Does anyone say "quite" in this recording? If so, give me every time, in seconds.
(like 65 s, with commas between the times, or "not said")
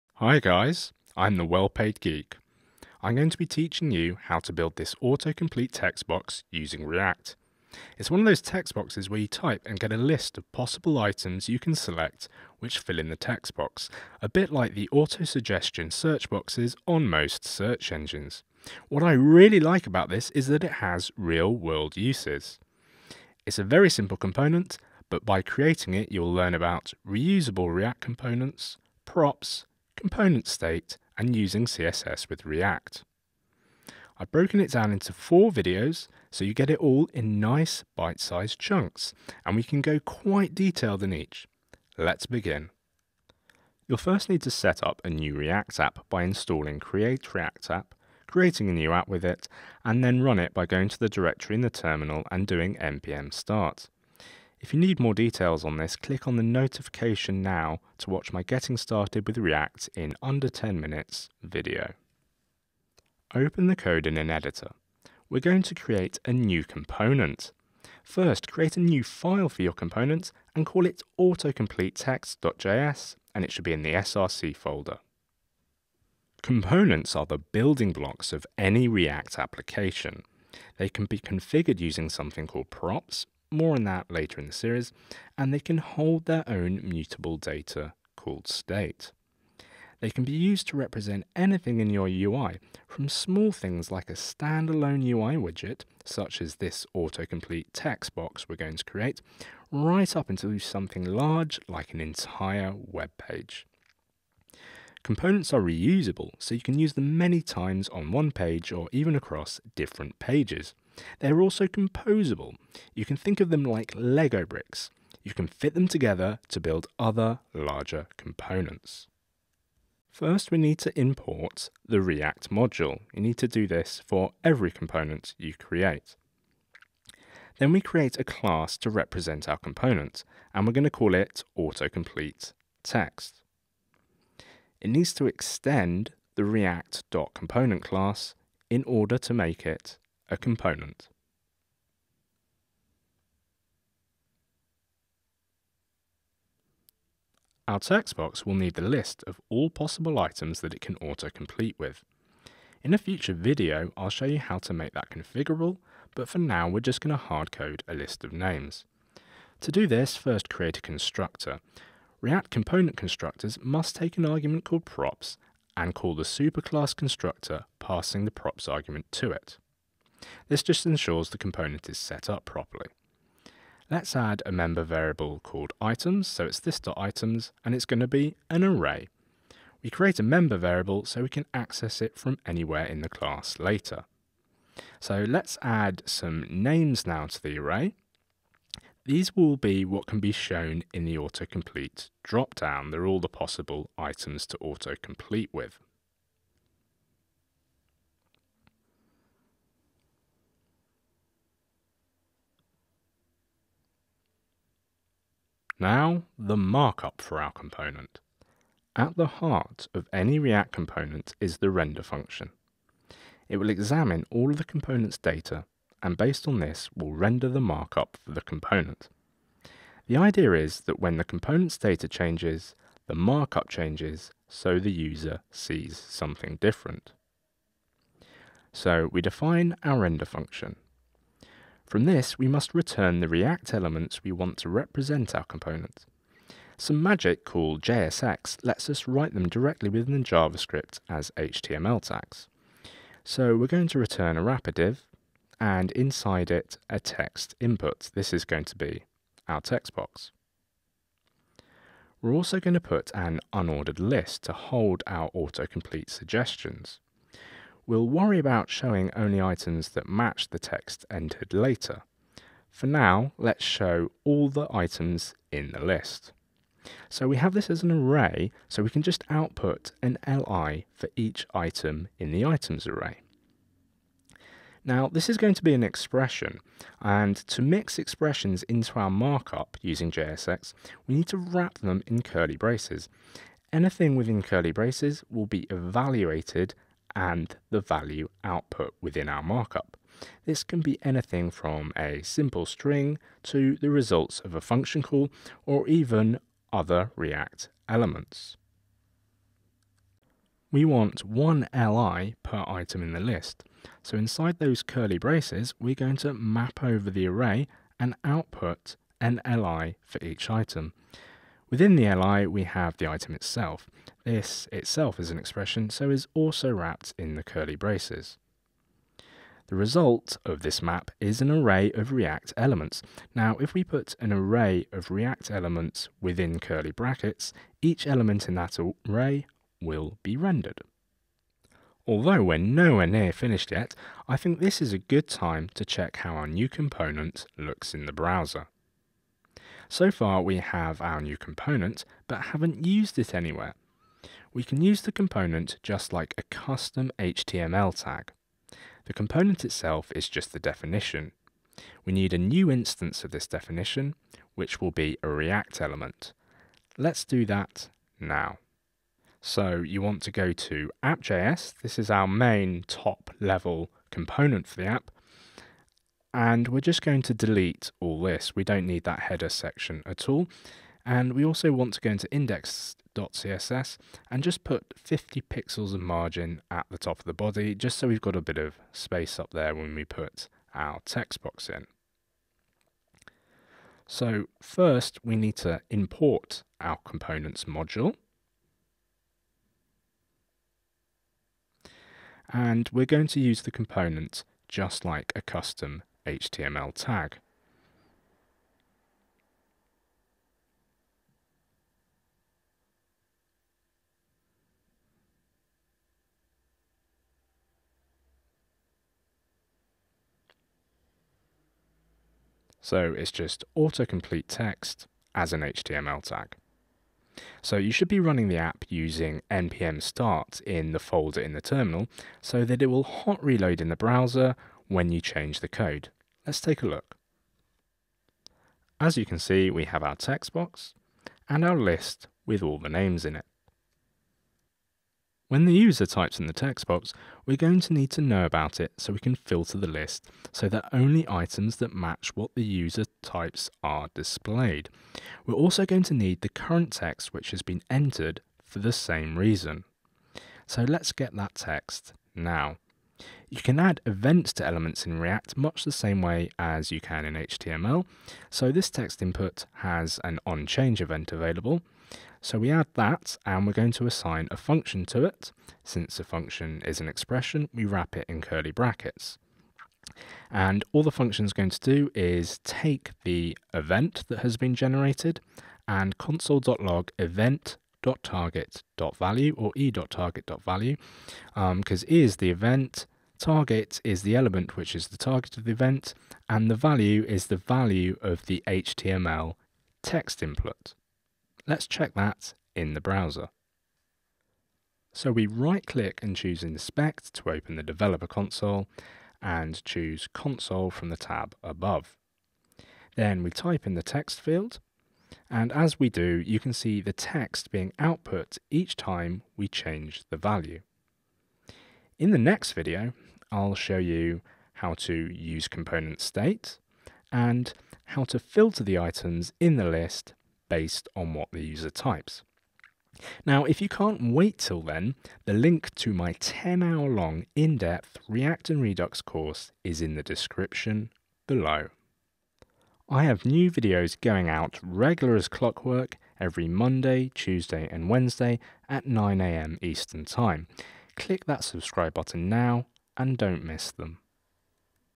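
39 s.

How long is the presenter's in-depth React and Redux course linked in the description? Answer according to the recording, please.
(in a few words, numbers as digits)
10 hours.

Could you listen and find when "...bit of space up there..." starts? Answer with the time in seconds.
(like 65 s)
378 s.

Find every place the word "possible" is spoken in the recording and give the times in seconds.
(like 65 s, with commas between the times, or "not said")
10 s, 149 s, 193 s.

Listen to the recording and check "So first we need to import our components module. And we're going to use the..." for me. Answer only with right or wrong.
right.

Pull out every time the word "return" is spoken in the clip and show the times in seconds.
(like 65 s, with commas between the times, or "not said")
232 s, 243 s.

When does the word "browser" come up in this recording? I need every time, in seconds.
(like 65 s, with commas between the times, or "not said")
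338 s, 423 s, 493 s.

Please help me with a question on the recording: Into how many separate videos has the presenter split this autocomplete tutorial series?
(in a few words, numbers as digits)
4.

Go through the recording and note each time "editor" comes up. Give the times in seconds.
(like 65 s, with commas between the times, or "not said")
64 s.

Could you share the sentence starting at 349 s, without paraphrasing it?
The component itself is just the definition.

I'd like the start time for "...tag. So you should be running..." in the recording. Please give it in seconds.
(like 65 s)
416 s.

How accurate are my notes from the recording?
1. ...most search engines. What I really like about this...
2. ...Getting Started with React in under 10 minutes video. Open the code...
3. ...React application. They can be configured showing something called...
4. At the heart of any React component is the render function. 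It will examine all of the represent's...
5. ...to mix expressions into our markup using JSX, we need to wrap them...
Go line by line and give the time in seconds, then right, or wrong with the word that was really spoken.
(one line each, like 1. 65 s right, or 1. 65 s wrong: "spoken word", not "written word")
1. 17 s right
2. 58 s right
3. 78 s wrong: "using", not "showing"
4. 208 s wrong: "component", not "represent"
5. 277 s right.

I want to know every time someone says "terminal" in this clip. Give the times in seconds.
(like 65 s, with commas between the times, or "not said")
51 s, 421 s.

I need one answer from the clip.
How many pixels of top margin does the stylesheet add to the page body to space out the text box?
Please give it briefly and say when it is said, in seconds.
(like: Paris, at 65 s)
50, at 374 s.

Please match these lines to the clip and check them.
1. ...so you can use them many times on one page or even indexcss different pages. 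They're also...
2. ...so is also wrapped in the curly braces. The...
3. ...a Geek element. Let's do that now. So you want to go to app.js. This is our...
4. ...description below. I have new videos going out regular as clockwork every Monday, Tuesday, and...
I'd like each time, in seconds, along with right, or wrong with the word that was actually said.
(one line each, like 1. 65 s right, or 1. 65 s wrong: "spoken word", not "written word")
1. 106 s wrong: "across", not "indexcss"
2. 315 s right
3. 355 s wrong: "React", not "Geek"
4. 530 s right.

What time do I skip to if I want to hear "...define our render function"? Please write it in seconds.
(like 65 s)
229 s.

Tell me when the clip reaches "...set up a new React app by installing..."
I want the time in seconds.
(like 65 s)
44 s.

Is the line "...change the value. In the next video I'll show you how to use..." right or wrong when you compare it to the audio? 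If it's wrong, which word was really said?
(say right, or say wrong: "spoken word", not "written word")
right.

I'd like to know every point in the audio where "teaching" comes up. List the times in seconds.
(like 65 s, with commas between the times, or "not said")
3 s.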